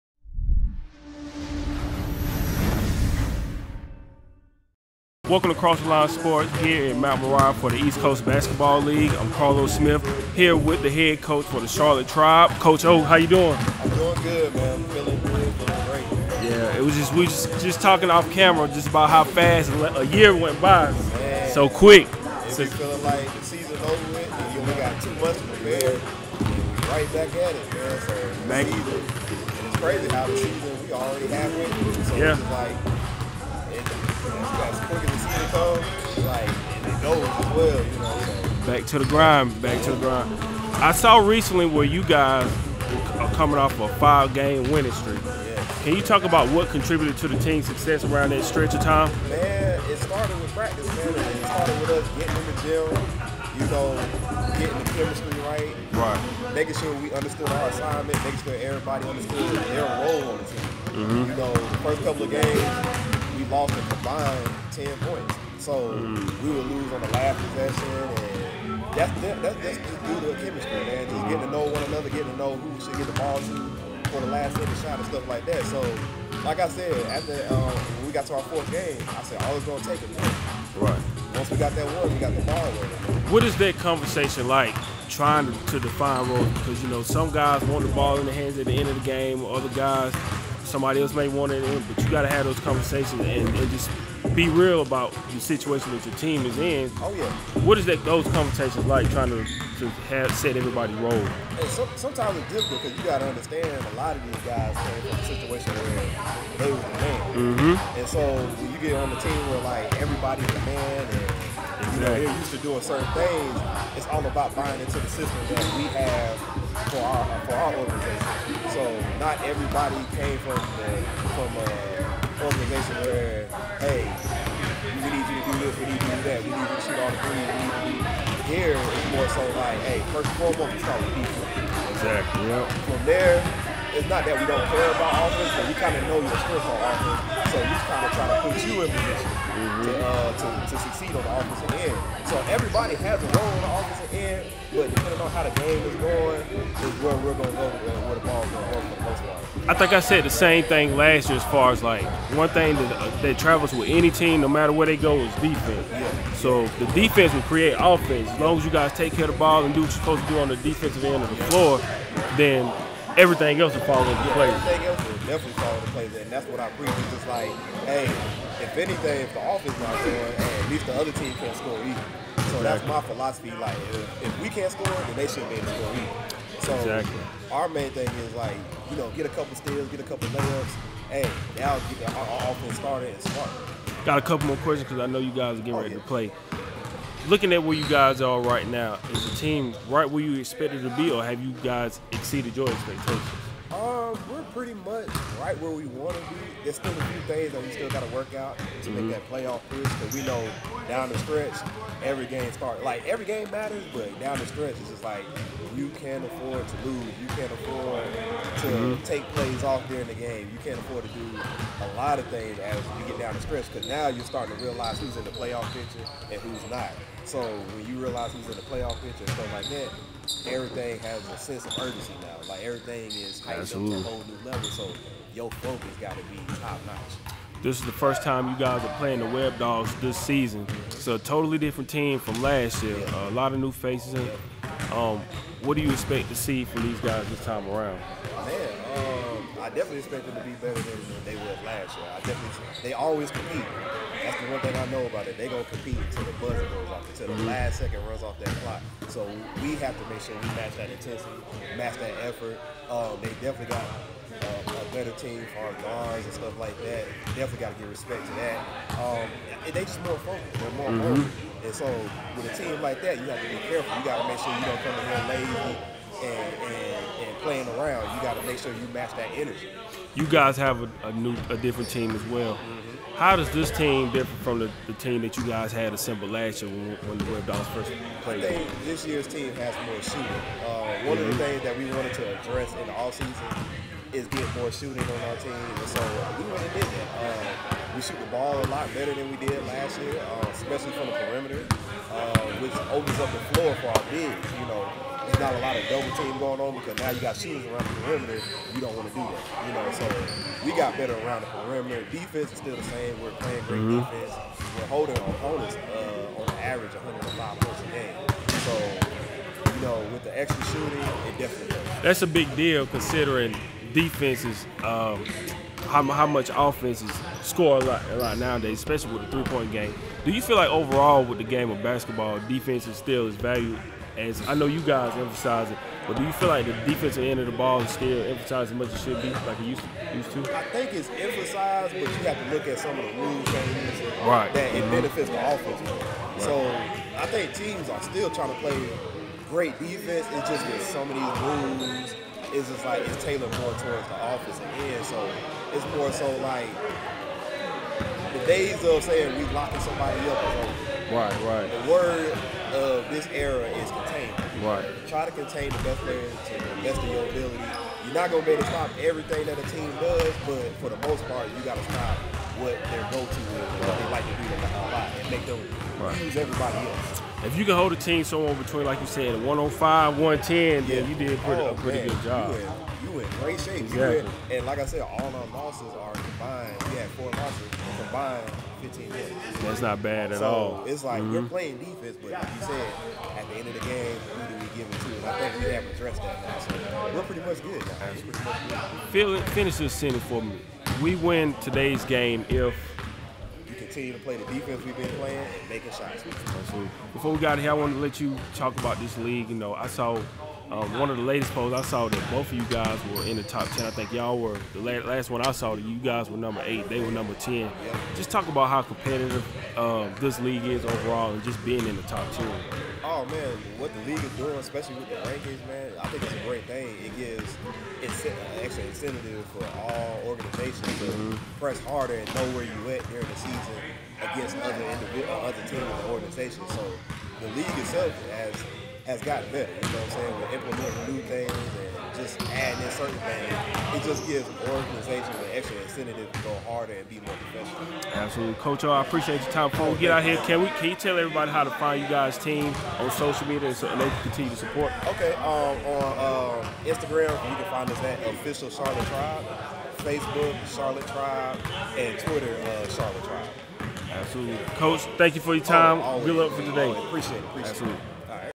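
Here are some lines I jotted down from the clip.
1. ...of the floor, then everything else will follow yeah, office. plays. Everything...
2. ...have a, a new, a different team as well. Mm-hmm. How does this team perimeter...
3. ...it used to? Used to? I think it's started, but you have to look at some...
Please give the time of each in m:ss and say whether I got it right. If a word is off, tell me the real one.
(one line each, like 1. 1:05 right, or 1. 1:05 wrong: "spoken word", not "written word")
1. 2:41 wrong: "place", not "office"
2. 4:30 wrong: "differ", not "perimeter"
3. 5:29 wrong: "emphasized", not "started".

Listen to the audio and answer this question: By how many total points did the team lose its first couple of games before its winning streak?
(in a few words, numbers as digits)
10.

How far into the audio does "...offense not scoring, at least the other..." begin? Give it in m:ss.
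2:49.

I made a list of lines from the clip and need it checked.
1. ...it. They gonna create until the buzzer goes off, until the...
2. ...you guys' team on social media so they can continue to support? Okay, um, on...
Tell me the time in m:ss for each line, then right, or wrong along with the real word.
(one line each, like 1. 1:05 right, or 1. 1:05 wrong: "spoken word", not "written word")
1. 4:05 wrong: "compete", not "create"
2. 7:22 right.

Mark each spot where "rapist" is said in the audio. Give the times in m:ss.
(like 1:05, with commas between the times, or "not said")
not said.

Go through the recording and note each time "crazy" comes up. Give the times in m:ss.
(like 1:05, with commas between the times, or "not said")
0:29.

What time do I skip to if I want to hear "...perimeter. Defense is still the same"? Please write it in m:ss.
5:01.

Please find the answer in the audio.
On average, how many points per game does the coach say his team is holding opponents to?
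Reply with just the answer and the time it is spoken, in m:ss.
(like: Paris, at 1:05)
105, at 5:06.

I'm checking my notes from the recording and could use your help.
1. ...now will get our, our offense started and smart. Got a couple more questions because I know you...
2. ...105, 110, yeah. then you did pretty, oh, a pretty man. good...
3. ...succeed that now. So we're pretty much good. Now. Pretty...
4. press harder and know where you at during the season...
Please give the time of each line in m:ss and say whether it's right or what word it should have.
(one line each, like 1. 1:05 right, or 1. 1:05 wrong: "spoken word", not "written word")
1. 3:01 right
2. 6:09 right
3. 6:25 wrong: "addressed", not "succeed"
4. 7:01 right.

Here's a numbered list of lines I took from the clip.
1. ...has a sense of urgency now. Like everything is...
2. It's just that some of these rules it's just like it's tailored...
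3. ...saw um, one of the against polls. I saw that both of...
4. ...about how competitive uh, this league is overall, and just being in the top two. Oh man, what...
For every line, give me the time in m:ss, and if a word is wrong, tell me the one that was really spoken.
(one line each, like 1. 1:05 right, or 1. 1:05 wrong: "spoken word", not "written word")
1. 3:40 right
2. 5:40 right
3. 6:39 wrong: "latest", not "against"
4. 6:48 right.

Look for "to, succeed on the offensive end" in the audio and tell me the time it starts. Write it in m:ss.
2:20.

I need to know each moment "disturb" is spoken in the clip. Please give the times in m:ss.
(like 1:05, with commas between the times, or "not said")
not said.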